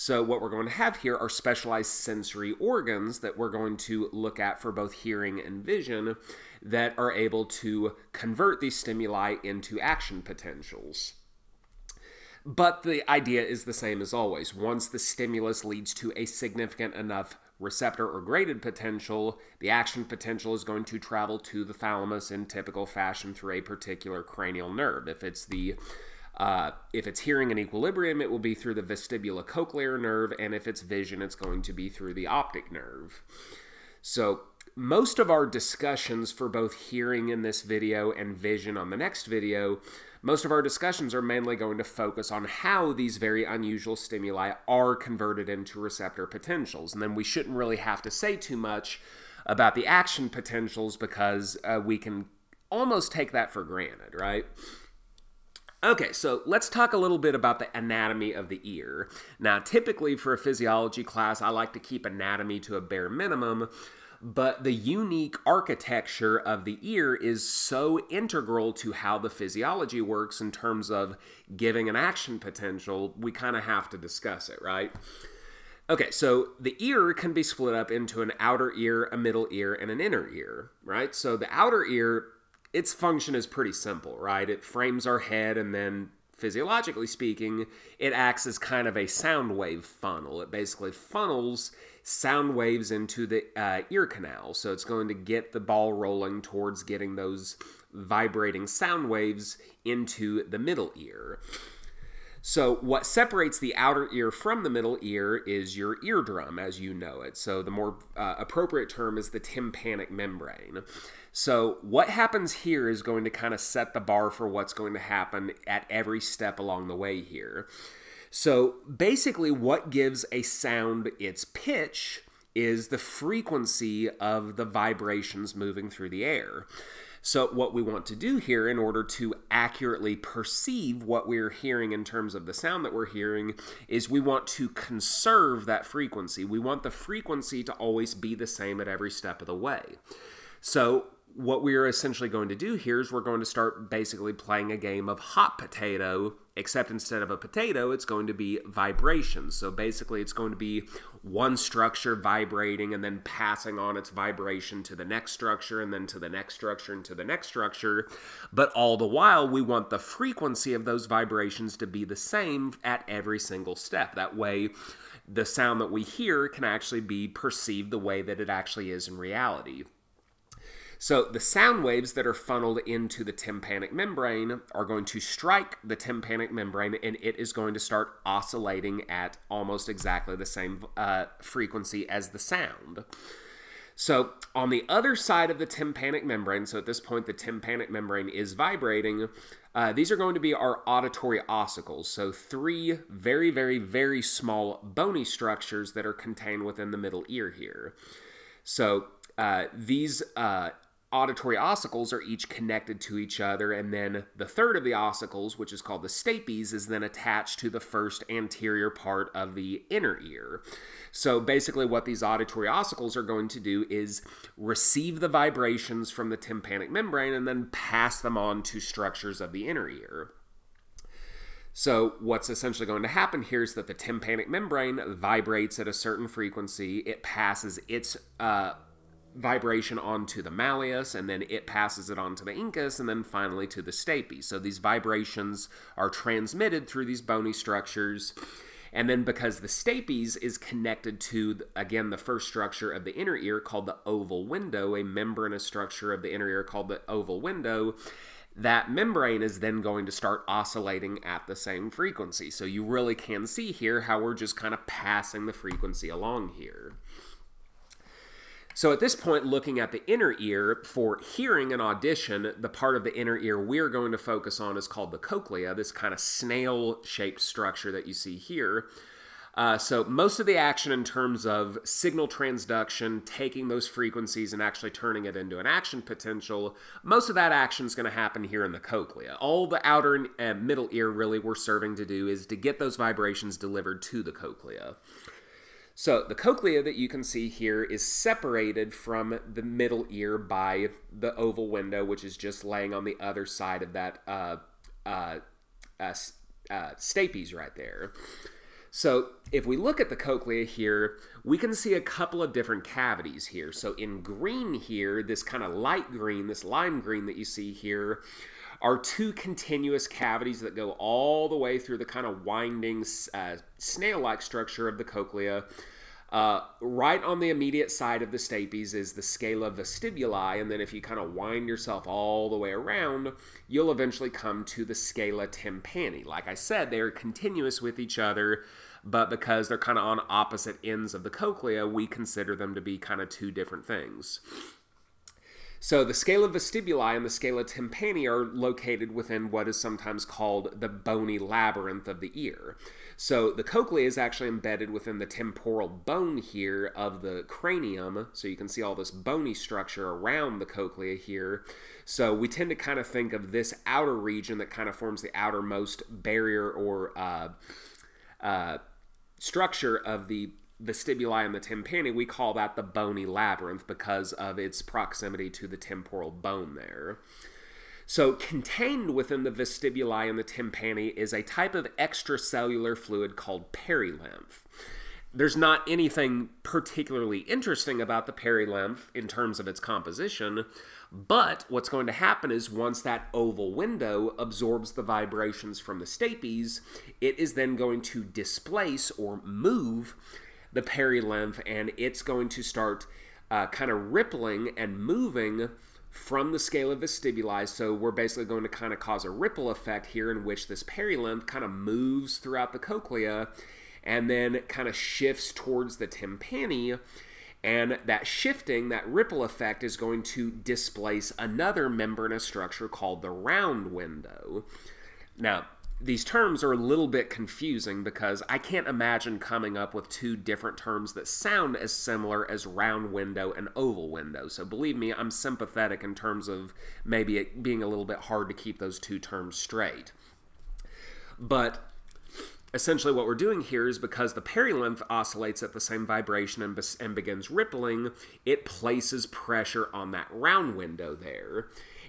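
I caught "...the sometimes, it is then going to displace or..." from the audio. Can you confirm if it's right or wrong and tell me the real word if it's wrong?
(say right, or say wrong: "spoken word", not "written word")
wrong: "stapes", not "sometimes".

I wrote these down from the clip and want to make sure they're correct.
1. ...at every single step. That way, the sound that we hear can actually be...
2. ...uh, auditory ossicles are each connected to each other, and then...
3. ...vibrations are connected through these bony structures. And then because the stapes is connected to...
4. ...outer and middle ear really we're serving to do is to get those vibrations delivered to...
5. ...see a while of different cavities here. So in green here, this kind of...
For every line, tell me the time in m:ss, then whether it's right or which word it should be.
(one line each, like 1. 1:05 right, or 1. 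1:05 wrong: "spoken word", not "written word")
1. 2:42 right
2. 3:20 right
3. 3:54 wrong: "transmitted", not "connected"
4. 4:39 right
5. 5:01 wrong: "couple", not "while".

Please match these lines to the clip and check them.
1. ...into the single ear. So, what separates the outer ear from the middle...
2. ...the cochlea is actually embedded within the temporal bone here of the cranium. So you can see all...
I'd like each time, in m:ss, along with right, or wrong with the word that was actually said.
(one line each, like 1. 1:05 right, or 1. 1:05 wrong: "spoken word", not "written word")
1. 1:39 wrong: "middle", not "single"
2. 5:43 right.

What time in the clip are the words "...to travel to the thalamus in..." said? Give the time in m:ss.
0:20.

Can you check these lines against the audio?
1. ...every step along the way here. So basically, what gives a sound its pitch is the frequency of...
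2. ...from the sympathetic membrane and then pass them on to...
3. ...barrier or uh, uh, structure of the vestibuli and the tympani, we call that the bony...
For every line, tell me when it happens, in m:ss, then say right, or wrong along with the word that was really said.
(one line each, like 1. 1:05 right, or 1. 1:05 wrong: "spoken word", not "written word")
1. 1:55 right
2. 3:36 wrong: "tympanic", not "sympathetic"
3. 5:56 right.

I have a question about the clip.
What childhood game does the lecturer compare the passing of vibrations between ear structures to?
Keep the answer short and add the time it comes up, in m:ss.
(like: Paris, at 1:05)
Hot potato, at 2:25.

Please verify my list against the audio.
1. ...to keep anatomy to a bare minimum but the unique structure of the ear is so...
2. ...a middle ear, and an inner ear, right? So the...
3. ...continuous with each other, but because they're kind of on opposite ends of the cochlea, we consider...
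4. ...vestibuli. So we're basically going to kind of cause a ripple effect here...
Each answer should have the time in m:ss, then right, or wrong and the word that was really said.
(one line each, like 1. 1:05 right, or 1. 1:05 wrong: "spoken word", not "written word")
1. 1:01 wrong: "architecture", not "structure"
2. 1:19 right
3. 5:27 right
4. 6:36 right.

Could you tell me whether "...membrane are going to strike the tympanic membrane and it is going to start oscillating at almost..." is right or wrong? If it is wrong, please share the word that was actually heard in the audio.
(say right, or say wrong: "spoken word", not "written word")
right.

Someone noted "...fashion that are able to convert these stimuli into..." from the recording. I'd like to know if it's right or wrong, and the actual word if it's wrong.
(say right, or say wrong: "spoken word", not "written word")
wrong: "vision", not "fashion".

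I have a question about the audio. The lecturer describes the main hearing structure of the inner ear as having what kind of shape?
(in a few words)
Snail shaped.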